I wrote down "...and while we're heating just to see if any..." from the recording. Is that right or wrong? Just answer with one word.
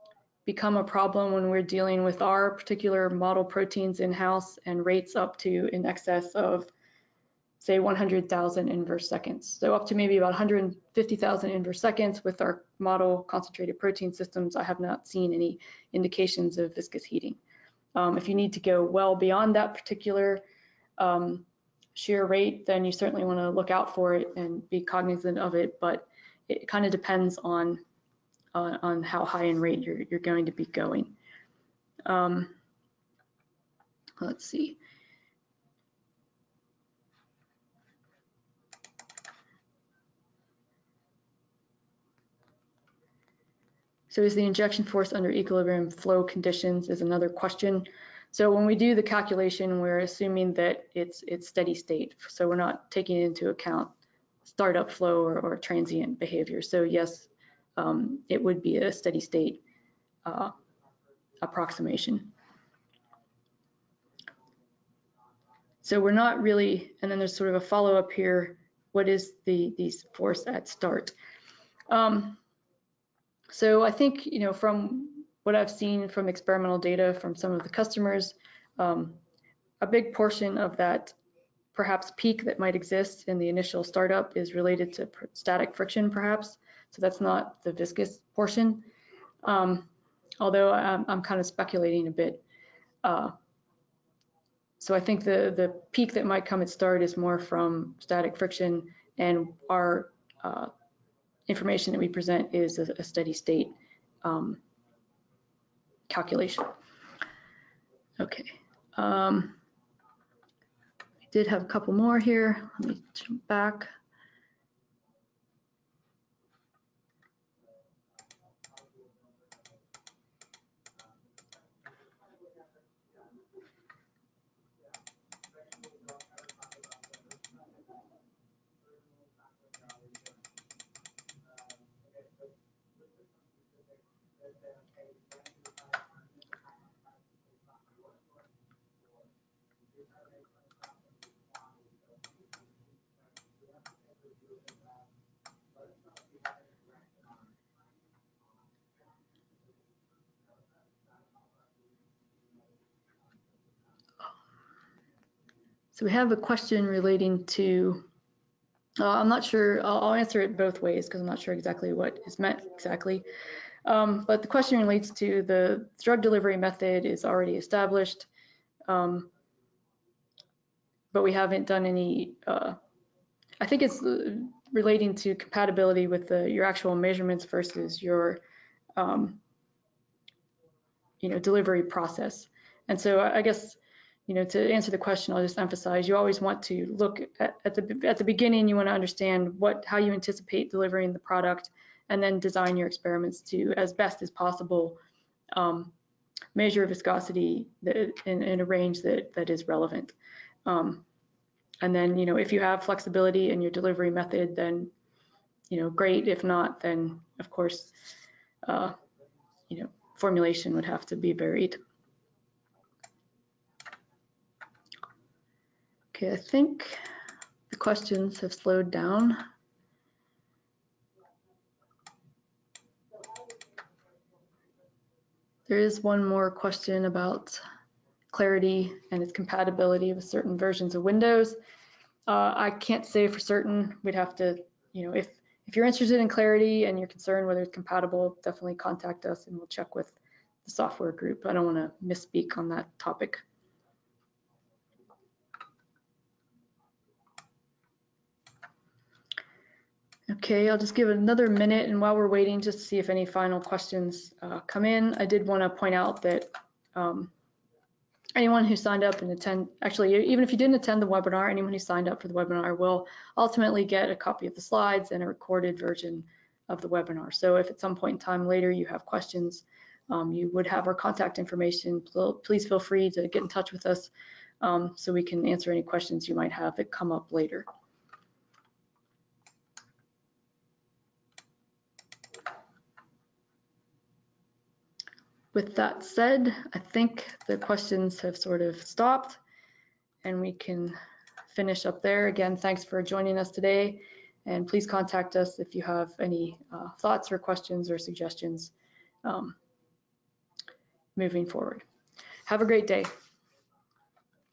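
wrong.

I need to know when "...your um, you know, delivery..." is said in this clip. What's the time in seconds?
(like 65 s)
178 s.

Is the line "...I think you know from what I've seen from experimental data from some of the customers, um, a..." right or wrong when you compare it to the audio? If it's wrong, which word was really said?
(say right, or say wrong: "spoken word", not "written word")
right.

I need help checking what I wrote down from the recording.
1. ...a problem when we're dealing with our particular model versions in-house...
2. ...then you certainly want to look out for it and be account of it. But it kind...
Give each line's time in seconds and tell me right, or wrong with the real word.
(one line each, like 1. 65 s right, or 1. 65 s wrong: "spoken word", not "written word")
1. 0 s wrong: "proteins", not "versions"
2. 22 s wrong: "cognizant", not "account".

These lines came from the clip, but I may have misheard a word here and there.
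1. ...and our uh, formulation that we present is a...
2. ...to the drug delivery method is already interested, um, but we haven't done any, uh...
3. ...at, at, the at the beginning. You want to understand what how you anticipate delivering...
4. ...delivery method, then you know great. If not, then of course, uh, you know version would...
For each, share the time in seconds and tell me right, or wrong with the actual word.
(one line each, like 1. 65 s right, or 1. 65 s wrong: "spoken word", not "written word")
1. 99 s wrong: "information", not "formulation"
2. 165 s wrong: "established", not "interested"
3. 187 s right
4. 203 s wrong: "formulation", not "version".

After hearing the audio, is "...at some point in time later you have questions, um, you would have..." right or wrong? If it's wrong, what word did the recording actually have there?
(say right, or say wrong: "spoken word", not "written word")
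right.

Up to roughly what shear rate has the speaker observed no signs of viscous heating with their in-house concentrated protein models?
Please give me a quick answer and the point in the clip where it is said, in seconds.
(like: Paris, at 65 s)
150,000 inverse seconds, at 10 s.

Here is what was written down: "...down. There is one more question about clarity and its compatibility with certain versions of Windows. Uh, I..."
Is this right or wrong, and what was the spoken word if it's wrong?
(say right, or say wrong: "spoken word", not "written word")
right.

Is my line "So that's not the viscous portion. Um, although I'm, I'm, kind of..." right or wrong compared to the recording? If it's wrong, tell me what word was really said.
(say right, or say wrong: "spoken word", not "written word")
right.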